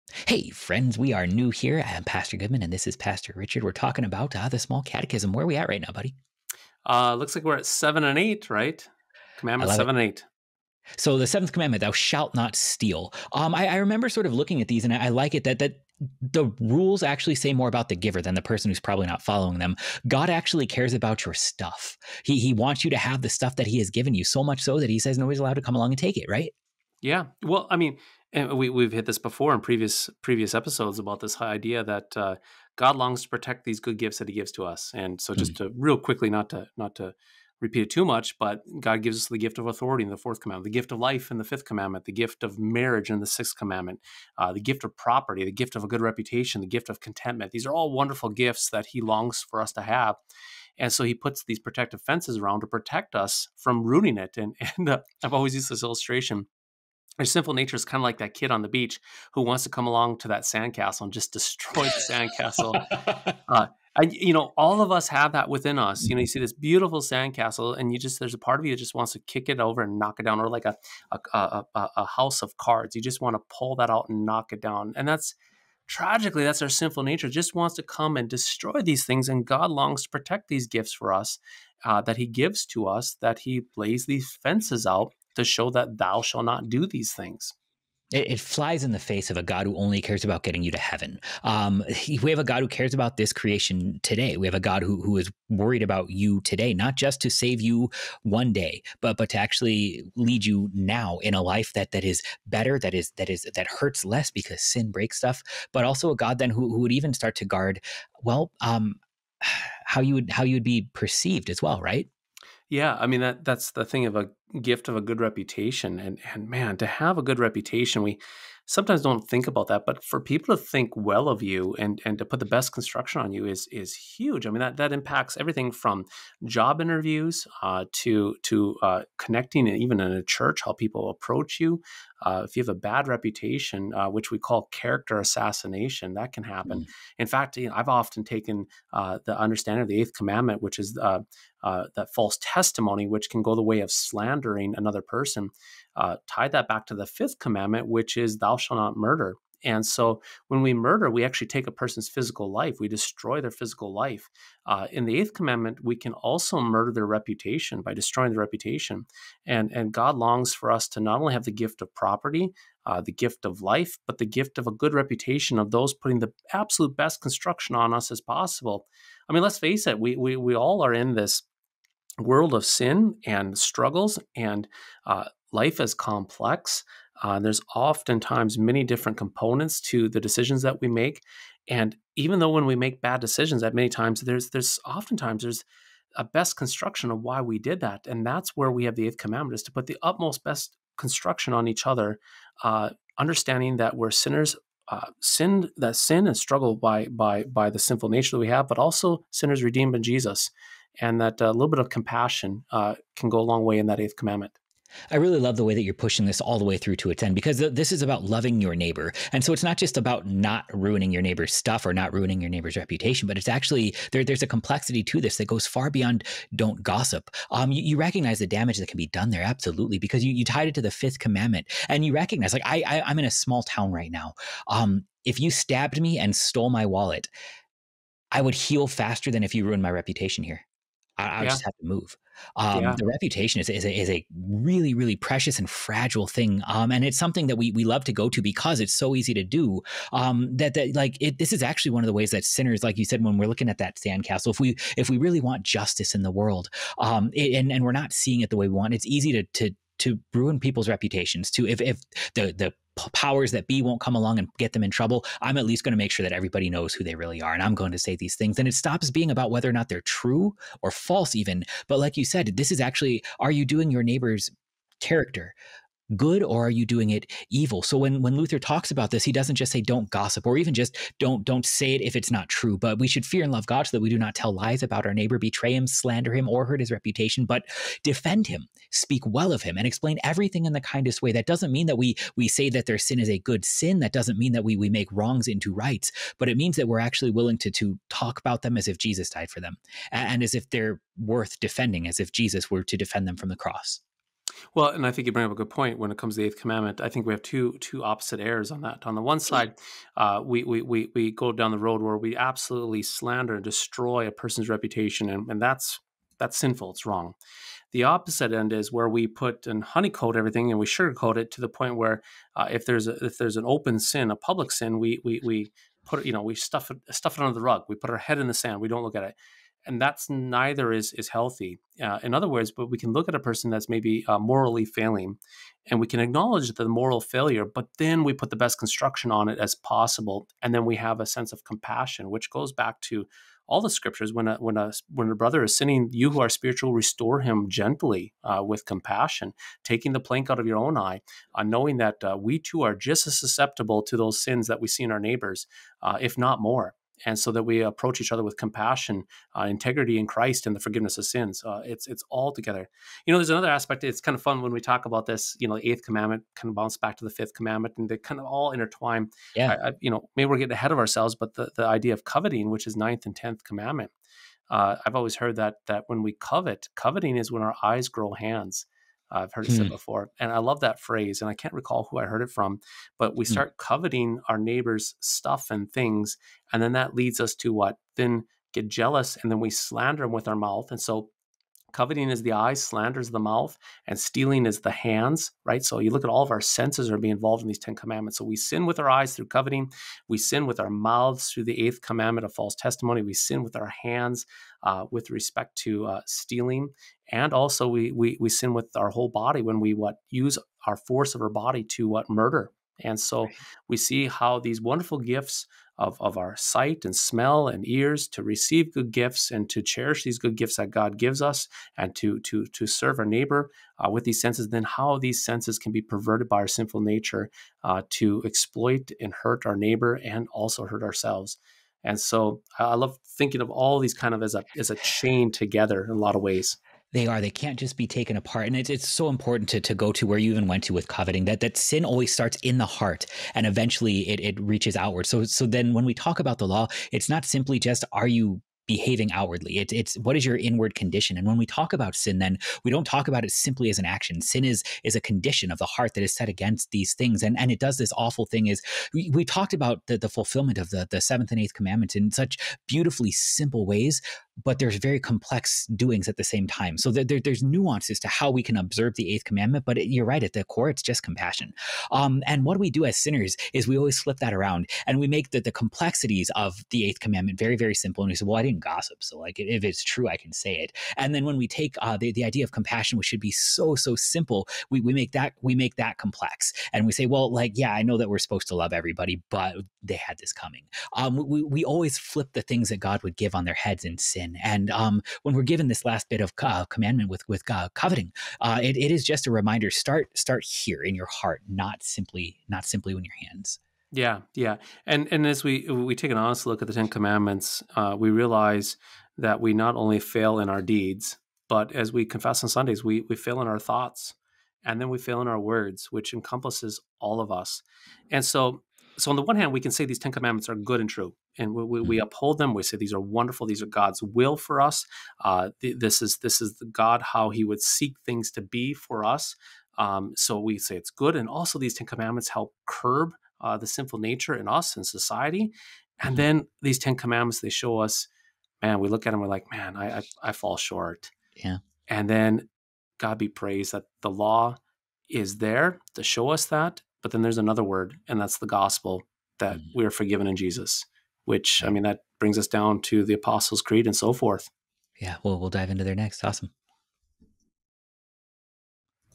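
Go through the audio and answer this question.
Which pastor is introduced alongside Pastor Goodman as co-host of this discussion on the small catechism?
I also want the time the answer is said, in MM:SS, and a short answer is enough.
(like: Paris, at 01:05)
Pastor Richard, at 00:02.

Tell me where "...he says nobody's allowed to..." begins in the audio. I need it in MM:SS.
00:24.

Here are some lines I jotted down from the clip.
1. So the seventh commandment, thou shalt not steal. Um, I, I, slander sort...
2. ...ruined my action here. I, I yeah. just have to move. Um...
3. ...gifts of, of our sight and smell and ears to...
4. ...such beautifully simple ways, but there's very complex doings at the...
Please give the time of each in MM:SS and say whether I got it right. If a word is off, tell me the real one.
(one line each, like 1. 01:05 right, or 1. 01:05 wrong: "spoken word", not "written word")
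1. 00:10 wrong: "remember", not "slander"
2. 03:49 wrong: "reputation", not "action"
3. 06:45 right
4. 07:32 right.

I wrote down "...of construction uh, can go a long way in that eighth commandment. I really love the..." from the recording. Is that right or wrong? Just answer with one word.
wrong.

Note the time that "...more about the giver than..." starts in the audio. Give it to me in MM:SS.
00:17.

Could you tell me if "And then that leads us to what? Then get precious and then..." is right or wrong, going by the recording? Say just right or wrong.
wrong.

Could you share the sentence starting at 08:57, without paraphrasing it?
But then there's another word, and that's the gospel that mm.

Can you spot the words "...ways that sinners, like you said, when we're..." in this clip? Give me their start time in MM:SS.
04:02.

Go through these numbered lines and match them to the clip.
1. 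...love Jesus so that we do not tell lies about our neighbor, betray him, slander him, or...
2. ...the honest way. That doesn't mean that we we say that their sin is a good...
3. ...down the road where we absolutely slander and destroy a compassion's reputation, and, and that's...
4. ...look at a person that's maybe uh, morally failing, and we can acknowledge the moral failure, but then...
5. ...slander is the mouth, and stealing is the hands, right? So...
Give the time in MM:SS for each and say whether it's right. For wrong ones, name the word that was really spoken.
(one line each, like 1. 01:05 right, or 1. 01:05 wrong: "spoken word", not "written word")
1. 04:33 wrong: "God", not "Jesus"
2. 04:40 wrong: "kindest", not "honest"
3. 05:01 wrong: "person", not "compassion"
4. 05:23 right
5. 06:22 right.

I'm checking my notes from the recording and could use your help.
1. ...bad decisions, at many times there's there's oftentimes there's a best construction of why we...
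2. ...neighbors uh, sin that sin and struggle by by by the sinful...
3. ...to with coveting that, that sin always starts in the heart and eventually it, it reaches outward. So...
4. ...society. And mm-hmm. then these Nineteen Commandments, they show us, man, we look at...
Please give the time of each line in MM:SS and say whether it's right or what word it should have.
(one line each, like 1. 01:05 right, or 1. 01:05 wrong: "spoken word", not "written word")
1. 03:03 right
2. 03:14 wrong: "sinners", not "neighbors"
3. 07:10 right
4. 08:45 wrong: "Ten", not "Nineteen".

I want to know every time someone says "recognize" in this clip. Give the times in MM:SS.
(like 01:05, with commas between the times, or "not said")
03:38, 03:42.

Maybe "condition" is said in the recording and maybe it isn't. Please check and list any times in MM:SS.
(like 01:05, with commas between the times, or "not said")
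07:20, 07:25.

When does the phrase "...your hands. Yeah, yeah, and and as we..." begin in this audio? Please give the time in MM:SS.
08:13.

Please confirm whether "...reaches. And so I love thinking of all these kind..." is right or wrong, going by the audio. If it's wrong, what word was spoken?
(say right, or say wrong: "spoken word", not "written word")
wrong: "ourselves", not "reaches".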